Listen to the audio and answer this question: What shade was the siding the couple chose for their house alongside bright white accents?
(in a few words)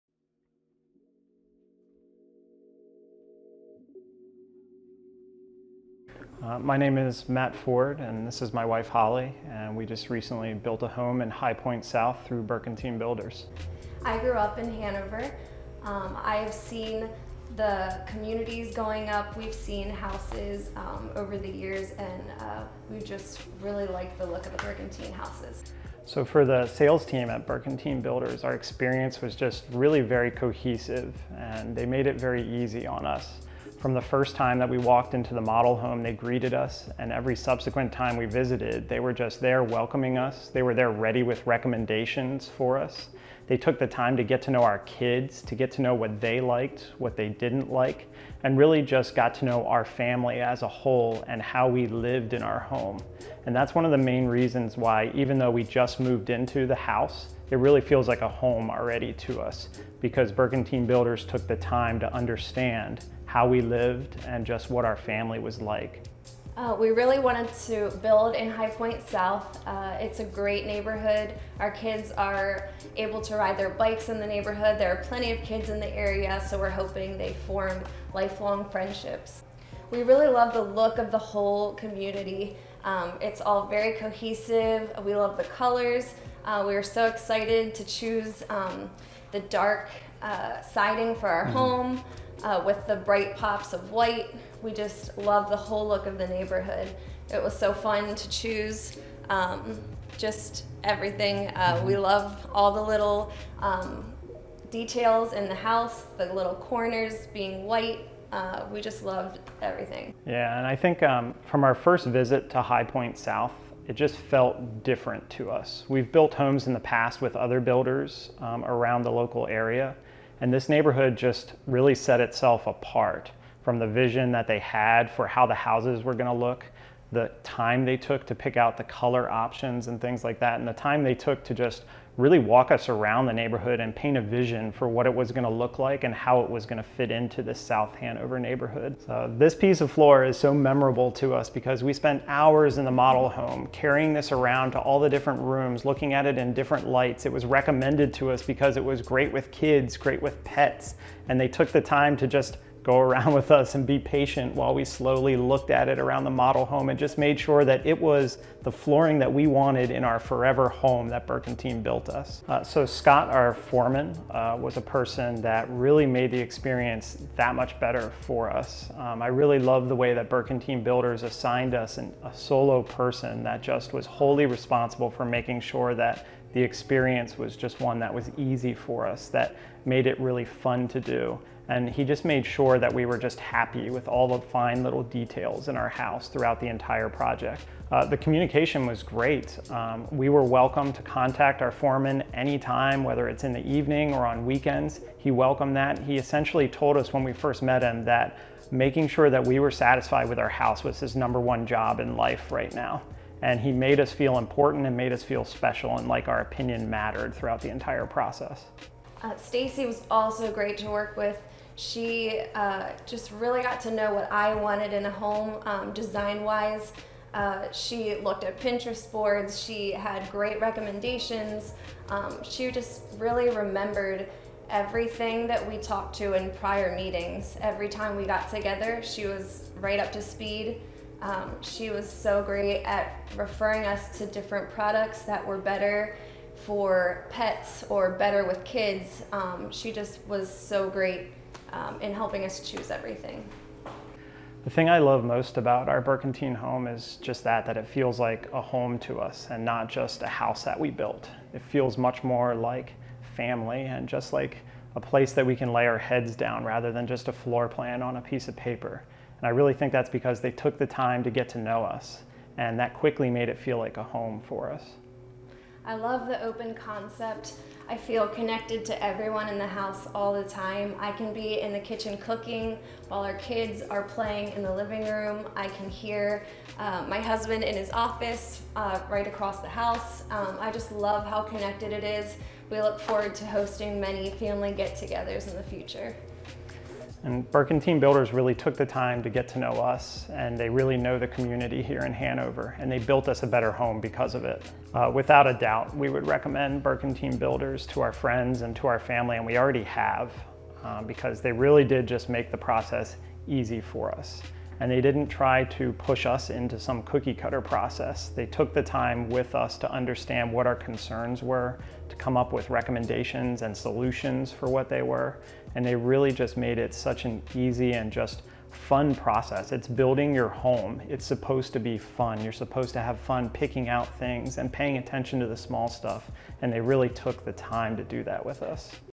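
dark.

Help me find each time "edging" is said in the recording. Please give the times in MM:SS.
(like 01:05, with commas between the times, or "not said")
not said.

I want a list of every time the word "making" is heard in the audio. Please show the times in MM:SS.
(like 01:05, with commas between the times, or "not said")
02:55, 03:18.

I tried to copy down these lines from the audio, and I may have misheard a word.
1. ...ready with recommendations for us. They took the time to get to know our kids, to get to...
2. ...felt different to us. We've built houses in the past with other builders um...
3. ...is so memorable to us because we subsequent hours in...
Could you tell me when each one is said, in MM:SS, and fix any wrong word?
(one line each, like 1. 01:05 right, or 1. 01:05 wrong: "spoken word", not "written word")
1. 00:40 right
2. 01:54 wrong: "homes", not "houses"
3. 02:20 wrong: "spent", not "subsequent".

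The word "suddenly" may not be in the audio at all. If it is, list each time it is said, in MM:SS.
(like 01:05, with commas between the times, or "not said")
not said.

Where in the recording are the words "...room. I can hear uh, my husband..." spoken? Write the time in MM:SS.
04:35.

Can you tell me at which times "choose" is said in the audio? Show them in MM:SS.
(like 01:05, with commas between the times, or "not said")
01:27, 01:38, 04:02.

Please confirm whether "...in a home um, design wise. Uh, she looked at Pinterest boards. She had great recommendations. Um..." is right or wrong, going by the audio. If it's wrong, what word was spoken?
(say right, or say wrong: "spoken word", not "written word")
right.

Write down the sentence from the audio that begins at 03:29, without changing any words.
Uh, Stacy was also great to work with.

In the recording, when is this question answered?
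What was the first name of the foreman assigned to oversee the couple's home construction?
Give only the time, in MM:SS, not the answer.
02:42.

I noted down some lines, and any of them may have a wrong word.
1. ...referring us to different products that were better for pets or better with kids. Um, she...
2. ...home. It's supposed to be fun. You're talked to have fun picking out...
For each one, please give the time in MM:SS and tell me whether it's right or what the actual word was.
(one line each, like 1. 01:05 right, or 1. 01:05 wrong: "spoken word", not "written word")
1. 03:53 right
2. 05:20 wrong: "supposed", not "talked".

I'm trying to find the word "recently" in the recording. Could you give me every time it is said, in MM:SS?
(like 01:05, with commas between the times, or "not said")
00:10.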